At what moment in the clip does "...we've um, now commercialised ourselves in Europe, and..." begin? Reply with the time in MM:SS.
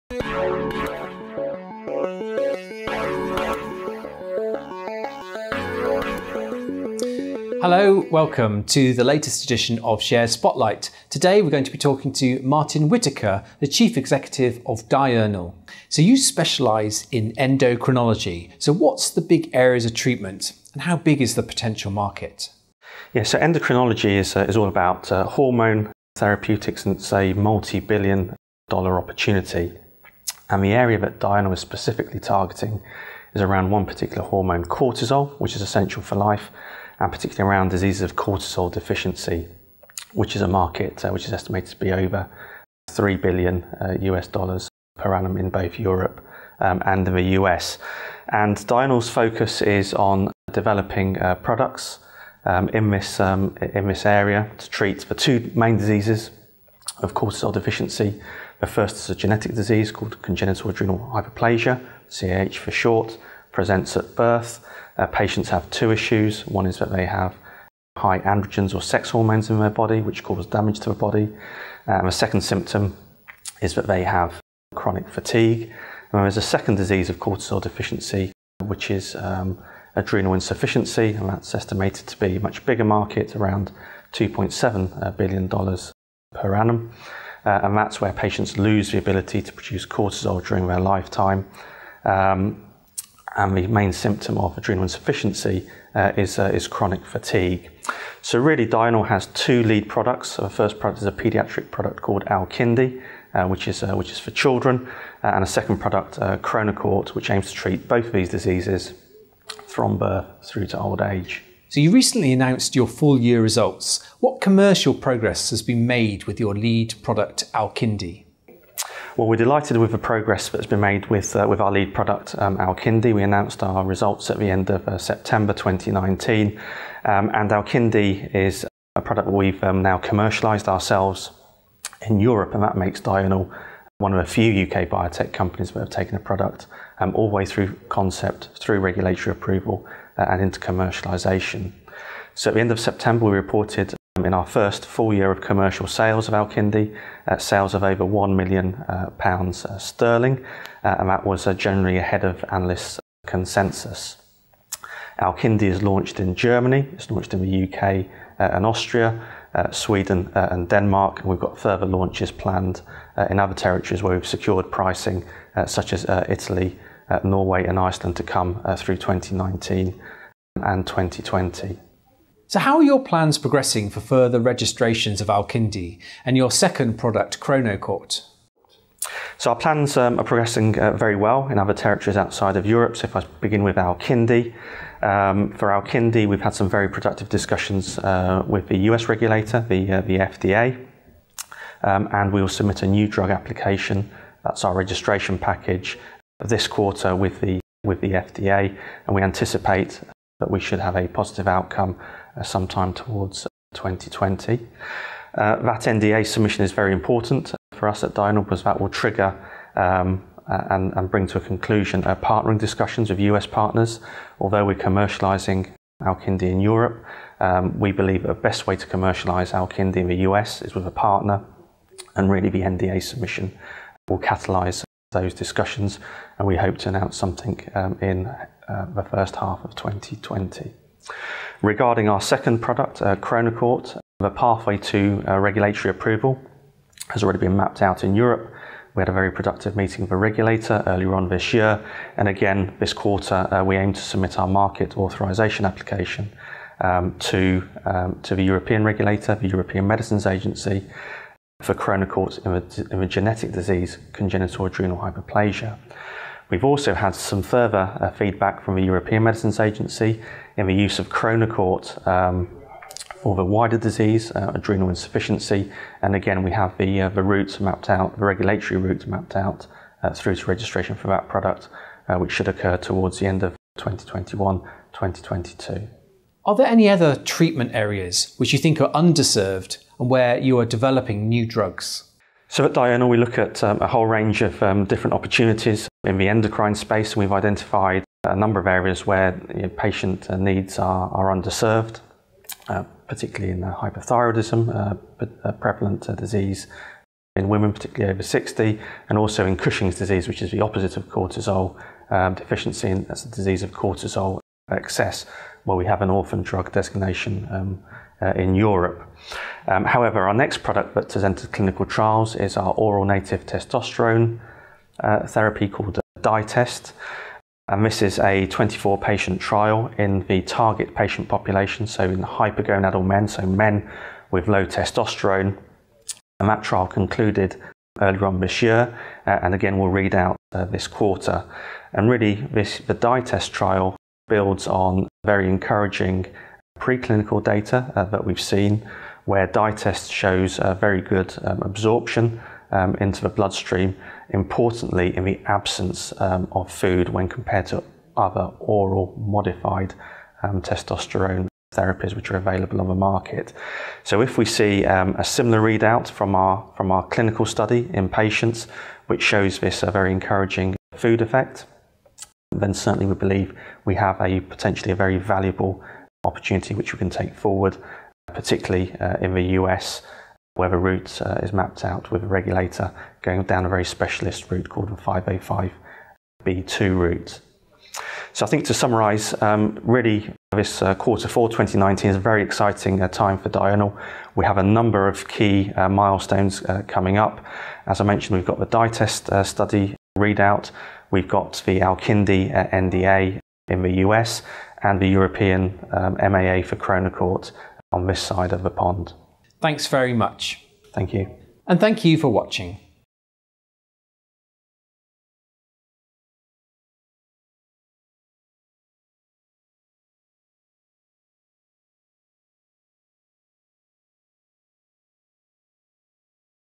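02:09.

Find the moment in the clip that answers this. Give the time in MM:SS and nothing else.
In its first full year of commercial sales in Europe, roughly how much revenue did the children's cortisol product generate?
02:27.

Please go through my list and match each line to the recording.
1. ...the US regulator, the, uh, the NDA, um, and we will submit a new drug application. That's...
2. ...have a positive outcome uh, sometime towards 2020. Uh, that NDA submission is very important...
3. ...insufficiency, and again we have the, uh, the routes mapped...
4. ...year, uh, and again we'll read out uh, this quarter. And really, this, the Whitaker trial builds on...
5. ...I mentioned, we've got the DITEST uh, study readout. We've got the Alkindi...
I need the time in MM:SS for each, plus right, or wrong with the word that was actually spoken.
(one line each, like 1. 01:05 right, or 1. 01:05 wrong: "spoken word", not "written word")
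1. 03:08 wrong: "FDA", not "NDA"
2. 03:20 right
3. 04:24 right
4. 05:28 wrong: "DITEST", not "Whitaker"
5. 06:27 right.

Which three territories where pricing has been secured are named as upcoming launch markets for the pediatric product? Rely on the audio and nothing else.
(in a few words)
Italy, Norway and Iceland.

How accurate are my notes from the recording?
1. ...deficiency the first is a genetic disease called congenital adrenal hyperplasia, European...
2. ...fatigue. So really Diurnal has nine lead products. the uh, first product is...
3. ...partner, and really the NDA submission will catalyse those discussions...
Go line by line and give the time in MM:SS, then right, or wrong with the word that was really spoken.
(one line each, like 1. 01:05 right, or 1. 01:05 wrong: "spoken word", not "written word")
1. 00:57 wrong: "CAH", not "European"
2. 01:37 wrong: "two", not "nine"
3. 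03:40 right.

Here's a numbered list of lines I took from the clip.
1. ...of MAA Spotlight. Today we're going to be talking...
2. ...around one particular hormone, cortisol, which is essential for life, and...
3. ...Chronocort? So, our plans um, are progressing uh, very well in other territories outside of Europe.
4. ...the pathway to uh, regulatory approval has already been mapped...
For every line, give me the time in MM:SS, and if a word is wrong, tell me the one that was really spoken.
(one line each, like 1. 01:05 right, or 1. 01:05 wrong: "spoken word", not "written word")
1. 00:09 wrong: "Share", not "MAA"
2. 00:33 right
3. 02:57 right
4. 03:54 right.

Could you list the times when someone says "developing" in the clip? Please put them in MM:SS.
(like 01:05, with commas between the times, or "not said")
00:50, 04:40.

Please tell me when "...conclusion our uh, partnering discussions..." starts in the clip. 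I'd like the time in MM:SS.
03:31.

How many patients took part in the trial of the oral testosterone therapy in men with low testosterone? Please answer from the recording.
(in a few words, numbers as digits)
24.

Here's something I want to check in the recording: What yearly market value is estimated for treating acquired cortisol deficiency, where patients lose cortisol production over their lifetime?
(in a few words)
$2.7 billion.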